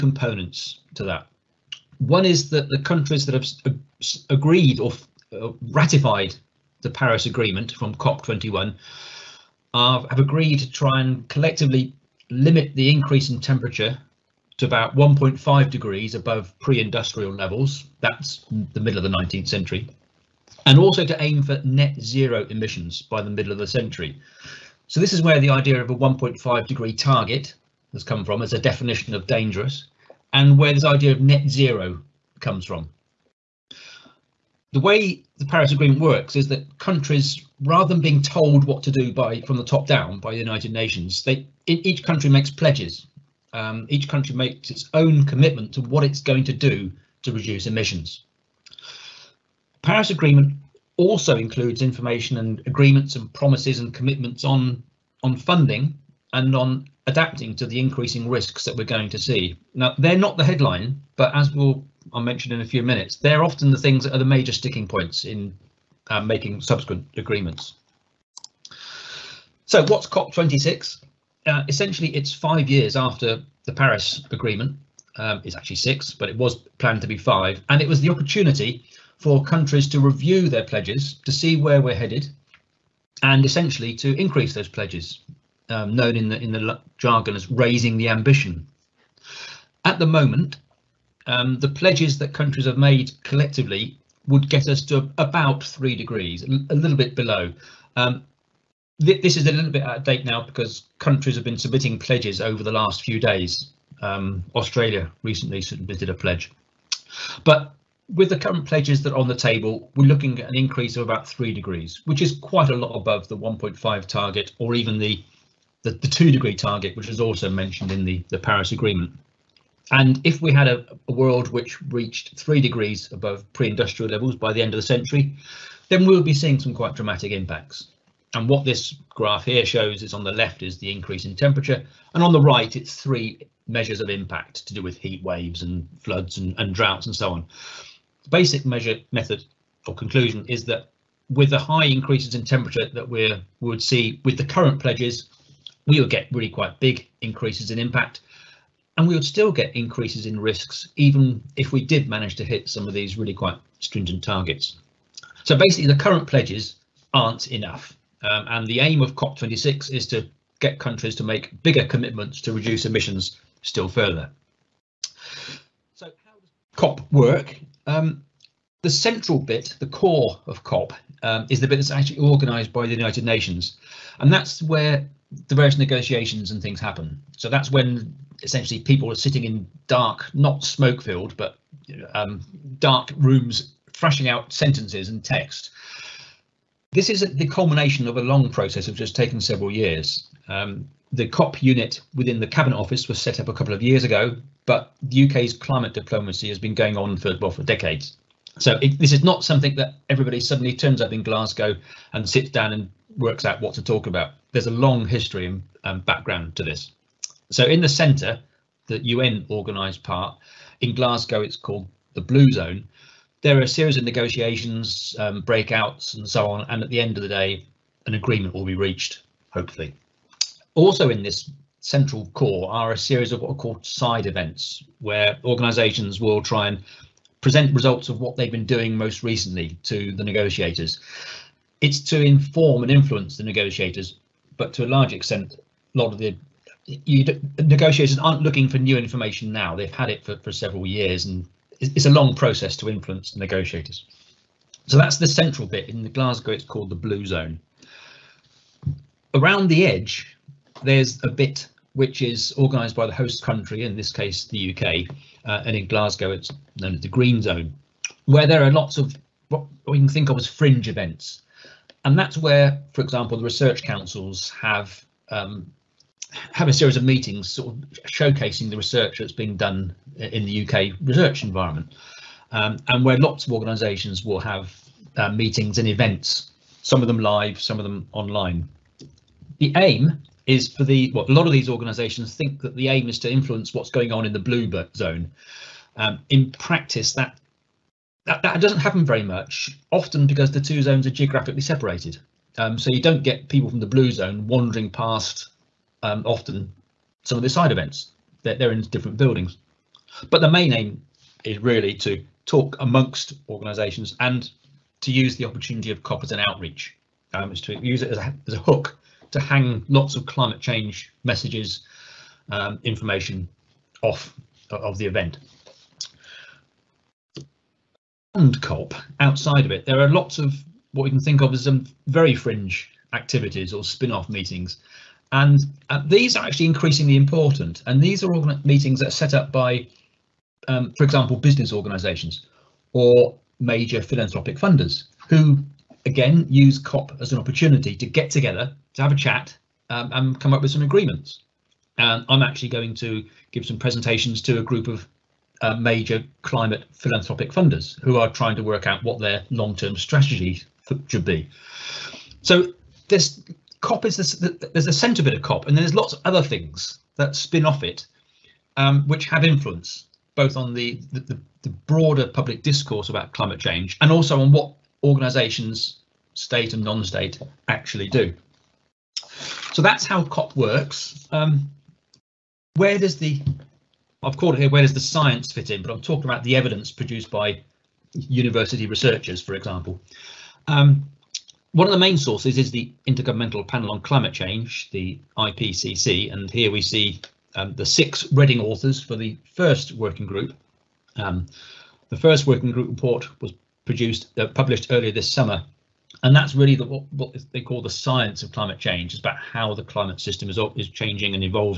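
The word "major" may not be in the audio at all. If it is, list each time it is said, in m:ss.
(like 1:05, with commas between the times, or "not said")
1:04, 5:33, 5:45.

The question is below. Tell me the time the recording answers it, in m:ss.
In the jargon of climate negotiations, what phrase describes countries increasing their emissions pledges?
1:27.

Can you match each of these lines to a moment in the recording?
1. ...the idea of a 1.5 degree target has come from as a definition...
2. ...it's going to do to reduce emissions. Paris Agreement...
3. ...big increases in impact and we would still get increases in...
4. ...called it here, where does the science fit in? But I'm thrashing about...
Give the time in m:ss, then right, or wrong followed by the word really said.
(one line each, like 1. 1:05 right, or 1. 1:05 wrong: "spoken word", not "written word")
1. 0:25 right
2. 0:46 right
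3. 2:26 right
4. 6:14 wrong: "talking", not "thrashing".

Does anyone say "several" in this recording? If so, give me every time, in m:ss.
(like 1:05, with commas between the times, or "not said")
3:09, 4:00.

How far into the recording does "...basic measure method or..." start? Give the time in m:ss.
2:18.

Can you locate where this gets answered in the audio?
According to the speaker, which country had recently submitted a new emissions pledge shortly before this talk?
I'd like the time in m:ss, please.
1:44.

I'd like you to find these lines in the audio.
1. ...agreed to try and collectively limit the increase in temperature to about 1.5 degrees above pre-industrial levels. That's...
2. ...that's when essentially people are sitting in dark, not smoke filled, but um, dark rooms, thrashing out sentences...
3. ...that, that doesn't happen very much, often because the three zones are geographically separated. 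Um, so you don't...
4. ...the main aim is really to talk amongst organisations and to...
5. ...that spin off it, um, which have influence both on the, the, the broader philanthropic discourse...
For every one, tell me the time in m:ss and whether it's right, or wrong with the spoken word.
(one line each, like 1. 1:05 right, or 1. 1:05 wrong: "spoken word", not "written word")
1. 0:10 right
2. 2:57 right
3. 4:48 wrong: "two", not "three"
4. 5:00 right
5. 5:57 wrong: "public", not "philanthropic".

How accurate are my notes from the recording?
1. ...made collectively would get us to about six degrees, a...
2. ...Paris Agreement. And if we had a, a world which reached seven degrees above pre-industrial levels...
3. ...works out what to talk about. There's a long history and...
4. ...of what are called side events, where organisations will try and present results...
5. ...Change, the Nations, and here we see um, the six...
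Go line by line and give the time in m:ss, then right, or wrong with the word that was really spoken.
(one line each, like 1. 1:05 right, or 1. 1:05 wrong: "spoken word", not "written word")
1. 1:32 wrong: "three", not "six"
2. 1:58 wrong: "three", not "seven"
3. 3:23 right
4. 3:43 right
5. 6:24 wrong: "IPCC", not "Nations".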